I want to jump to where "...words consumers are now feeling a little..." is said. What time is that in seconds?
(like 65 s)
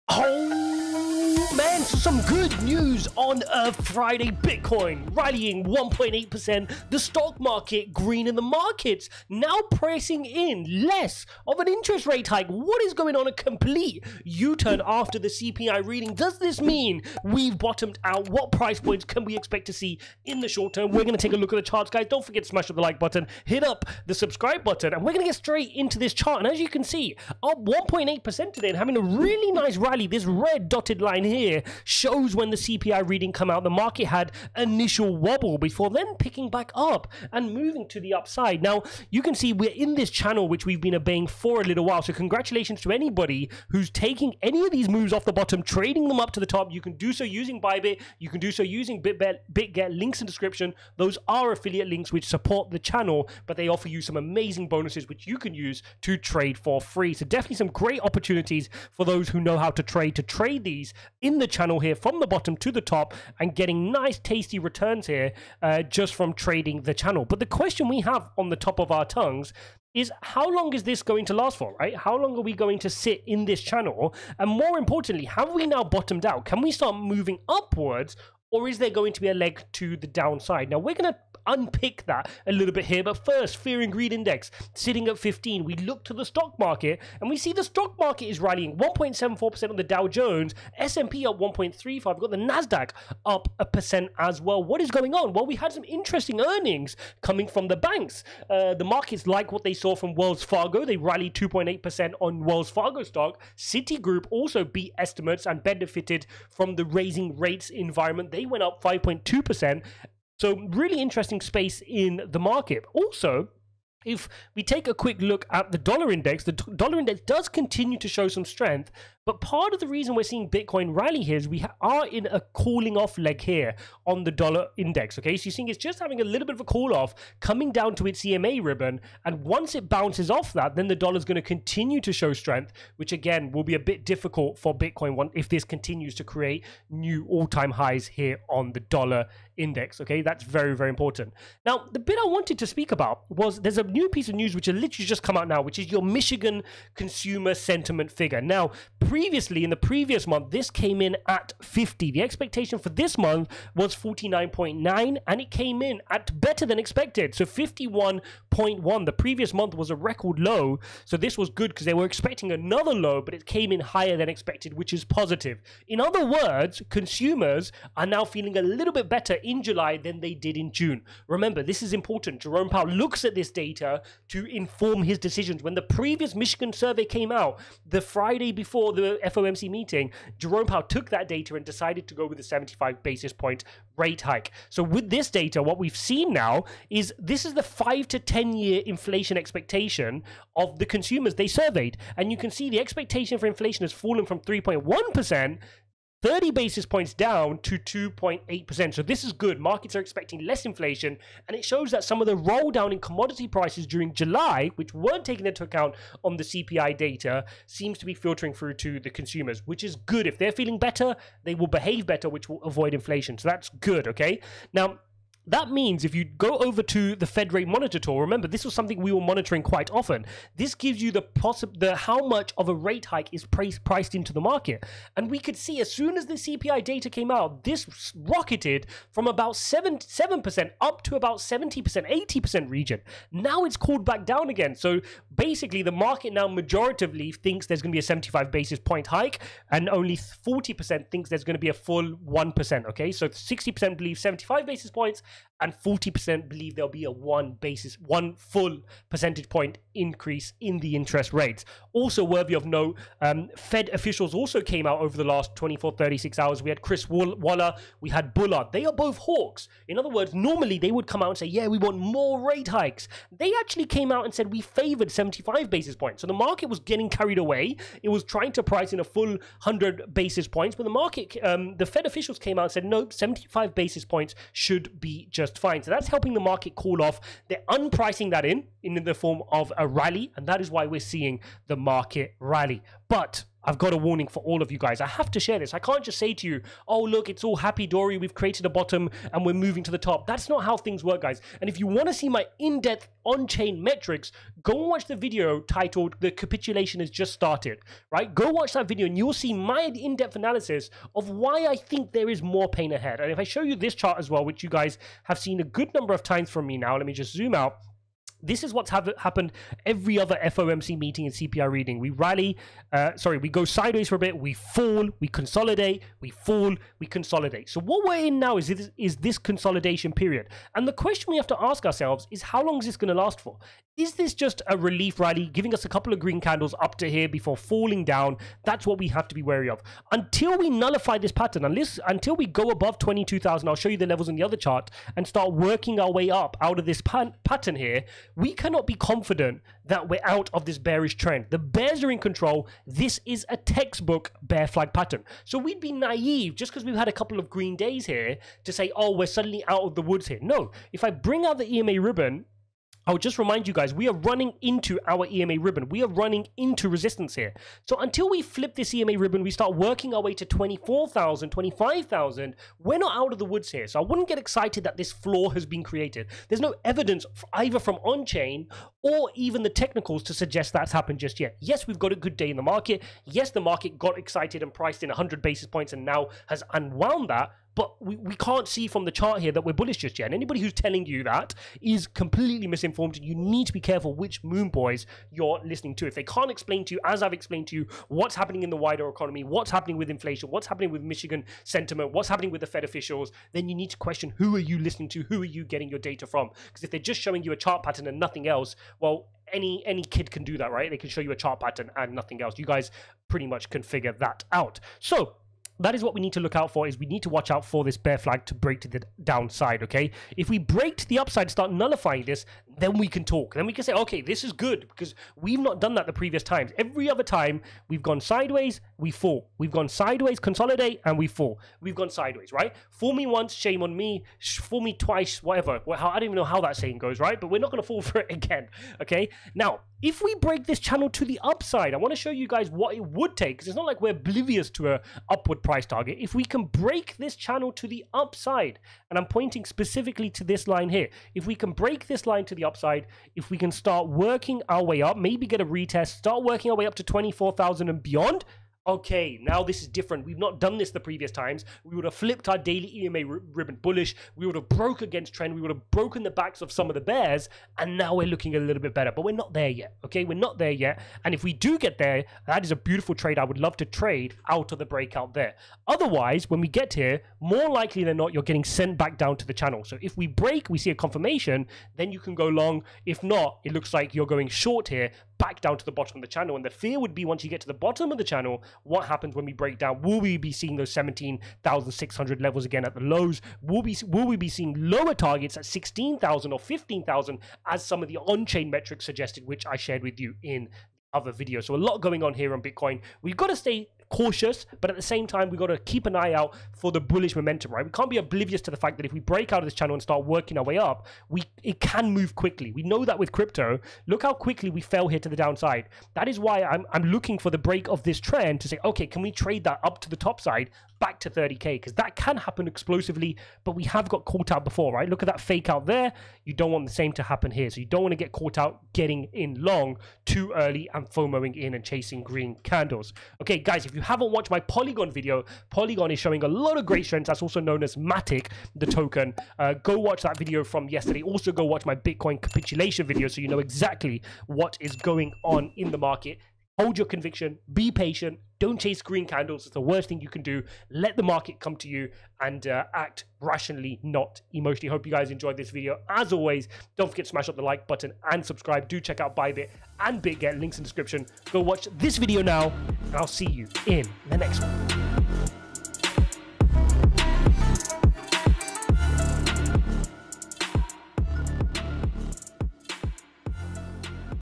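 166 s.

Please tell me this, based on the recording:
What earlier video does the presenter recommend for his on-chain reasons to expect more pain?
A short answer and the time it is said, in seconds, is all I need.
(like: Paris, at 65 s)
The Capitulation Has Just Started, at 296 s.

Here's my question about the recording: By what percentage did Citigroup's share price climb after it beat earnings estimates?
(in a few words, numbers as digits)
5.2%.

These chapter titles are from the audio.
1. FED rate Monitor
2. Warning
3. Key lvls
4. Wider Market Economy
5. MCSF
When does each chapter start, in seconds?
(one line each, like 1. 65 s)
1. 223 s
2. 285 s
3. 465 s
4. 85 s
5. 146 s.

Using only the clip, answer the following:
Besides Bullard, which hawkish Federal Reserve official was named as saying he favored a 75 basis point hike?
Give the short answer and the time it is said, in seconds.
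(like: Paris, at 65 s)
Chris Waller, at 256 s.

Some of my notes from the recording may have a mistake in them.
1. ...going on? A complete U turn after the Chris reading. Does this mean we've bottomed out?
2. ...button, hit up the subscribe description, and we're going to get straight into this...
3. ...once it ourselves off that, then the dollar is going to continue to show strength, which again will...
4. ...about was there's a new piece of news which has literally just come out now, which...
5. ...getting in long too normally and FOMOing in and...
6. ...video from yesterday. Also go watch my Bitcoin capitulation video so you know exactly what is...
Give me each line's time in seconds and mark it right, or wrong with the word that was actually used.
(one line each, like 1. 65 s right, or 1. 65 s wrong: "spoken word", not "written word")
1. 12 s wrong: "CPI", not "Chris"
2. 22 s wrong: "button", not "description"
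3. 129 s wrong: "bounces", not "ourselves"
4. 142 s right
5. 518 s wrong: "early", not "normally"
6. 530 s right.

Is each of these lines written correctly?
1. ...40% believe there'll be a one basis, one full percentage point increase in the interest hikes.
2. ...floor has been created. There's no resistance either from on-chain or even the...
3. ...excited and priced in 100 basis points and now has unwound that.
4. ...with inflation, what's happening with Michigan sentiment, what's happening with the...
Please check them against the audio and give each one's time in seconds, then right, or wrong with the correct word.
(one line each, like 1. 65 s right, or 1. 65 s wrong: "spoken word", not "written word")
1. 245 s wrong: "rates", not "hikes"
2. 365 s wrong: "evidence", not "resistance"
3. 374 s right
4. 389 s right.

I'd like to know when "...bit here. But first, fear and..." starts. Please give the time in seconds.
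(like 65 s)
82 s.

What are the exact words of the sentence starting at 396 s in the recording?
Because if they're just showing you a chart pattern and nothing else, well, any any kid can do that, right?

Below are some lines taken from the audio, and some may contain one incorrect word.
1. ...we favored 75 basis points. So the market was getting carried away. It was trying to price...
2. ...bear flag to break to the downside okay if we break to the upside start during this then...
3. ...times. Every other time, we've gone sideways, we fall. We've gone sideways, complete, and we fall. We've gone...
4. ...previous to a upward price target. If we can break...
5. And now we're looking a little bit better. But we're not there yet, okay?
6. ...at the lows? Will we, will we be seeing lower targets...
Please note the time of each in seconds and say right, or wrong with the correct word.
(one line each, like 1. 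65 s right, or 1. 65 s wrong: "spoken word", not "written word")
1. 264 s right
2. 407 s wrong: "nullifying", not "during"
3. 416 s wrong: "consolidate", not "complete"
4. 434 s wrong: "oblivious", not "previous"
5. 457 s right
6. 482 s right.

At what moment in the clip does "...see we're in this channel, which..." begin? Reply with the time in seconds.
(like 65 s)
39 s.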